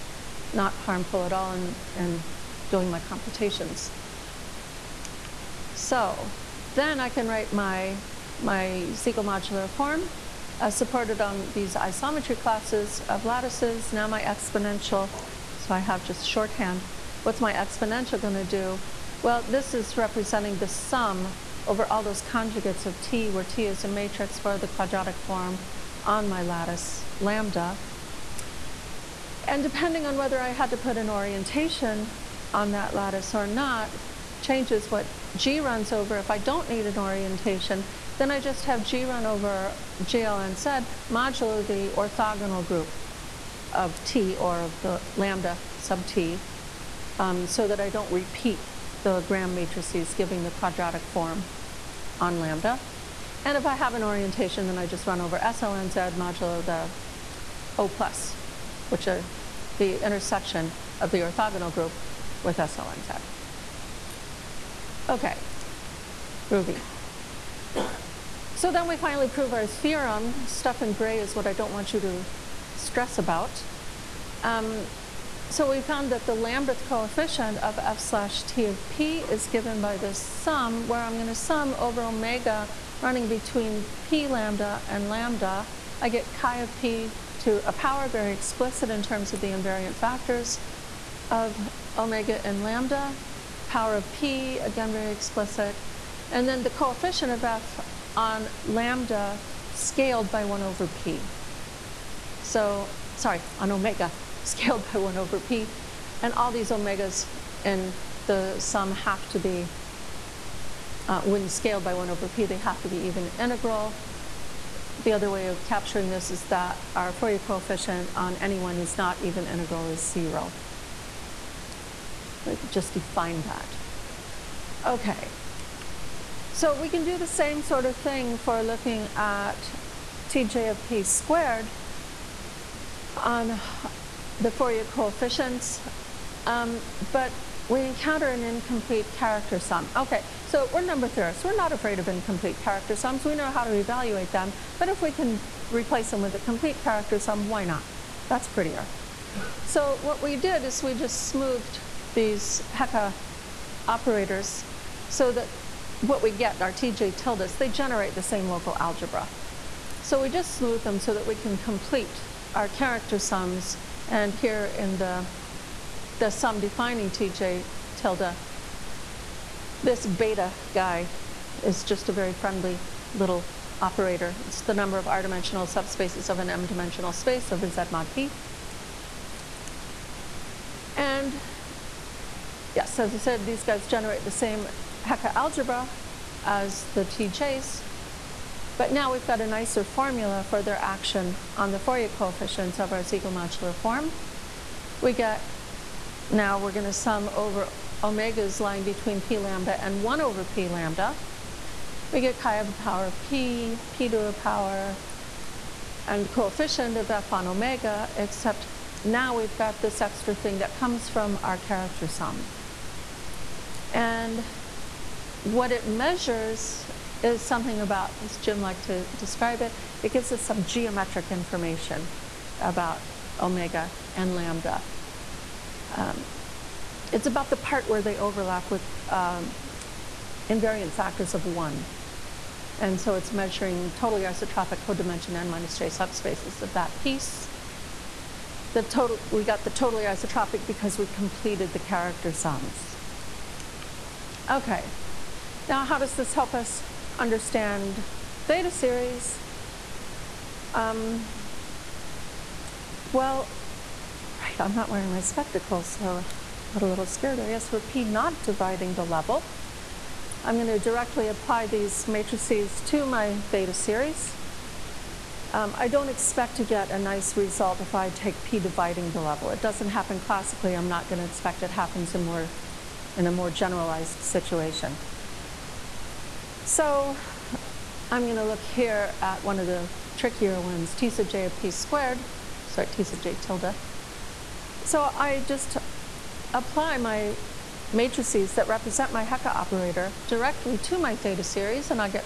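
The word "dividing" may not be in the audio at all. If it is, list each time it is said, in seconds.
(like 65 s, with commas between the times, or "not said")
258 s, 268 s.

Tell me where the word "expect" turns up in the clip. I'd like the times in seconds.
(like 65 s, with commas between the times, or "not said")
266 s, 271 s.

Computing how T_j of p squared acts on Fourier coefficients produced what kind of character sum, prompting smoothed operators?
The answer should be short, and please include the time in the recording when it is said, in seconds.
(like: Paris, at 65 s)
incomplete character sum, at 142 s.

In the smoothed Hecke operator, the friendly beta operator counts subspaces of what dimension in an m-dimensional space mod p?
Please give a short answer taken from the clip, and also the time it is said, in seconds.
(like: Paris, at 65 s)
r-dimensional, at 175 s.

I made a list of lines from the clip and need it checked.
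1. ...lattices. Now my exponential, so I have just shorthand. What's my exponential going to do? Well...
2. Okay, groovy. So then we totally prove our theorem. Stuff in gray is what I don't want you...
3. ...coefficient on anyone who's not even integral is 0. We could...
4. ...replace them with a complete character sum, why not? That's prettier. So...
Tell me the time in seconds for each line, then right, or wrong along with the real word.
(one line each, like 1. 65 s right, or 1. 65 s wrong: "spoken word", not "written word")
1. 13 s right
2. 65 s wrong: "finally", not "totally"
3. 117 s right
4. 145 s right.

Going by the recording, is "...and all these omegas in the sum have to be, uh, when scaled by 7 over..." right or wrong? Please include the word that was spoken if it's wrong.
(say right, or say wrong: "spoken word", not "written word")
wrong: "1", not "7".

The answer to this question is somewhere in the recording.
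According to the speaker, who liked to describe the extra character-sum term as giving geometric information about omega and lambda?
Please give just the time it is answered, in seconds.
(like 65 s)
218 s.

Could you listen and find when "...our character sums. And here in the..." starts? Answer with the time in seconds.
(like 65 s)
162 s.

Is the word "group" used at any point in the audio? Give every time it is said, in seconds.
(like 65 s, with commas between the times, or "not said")
42 s, 61 s.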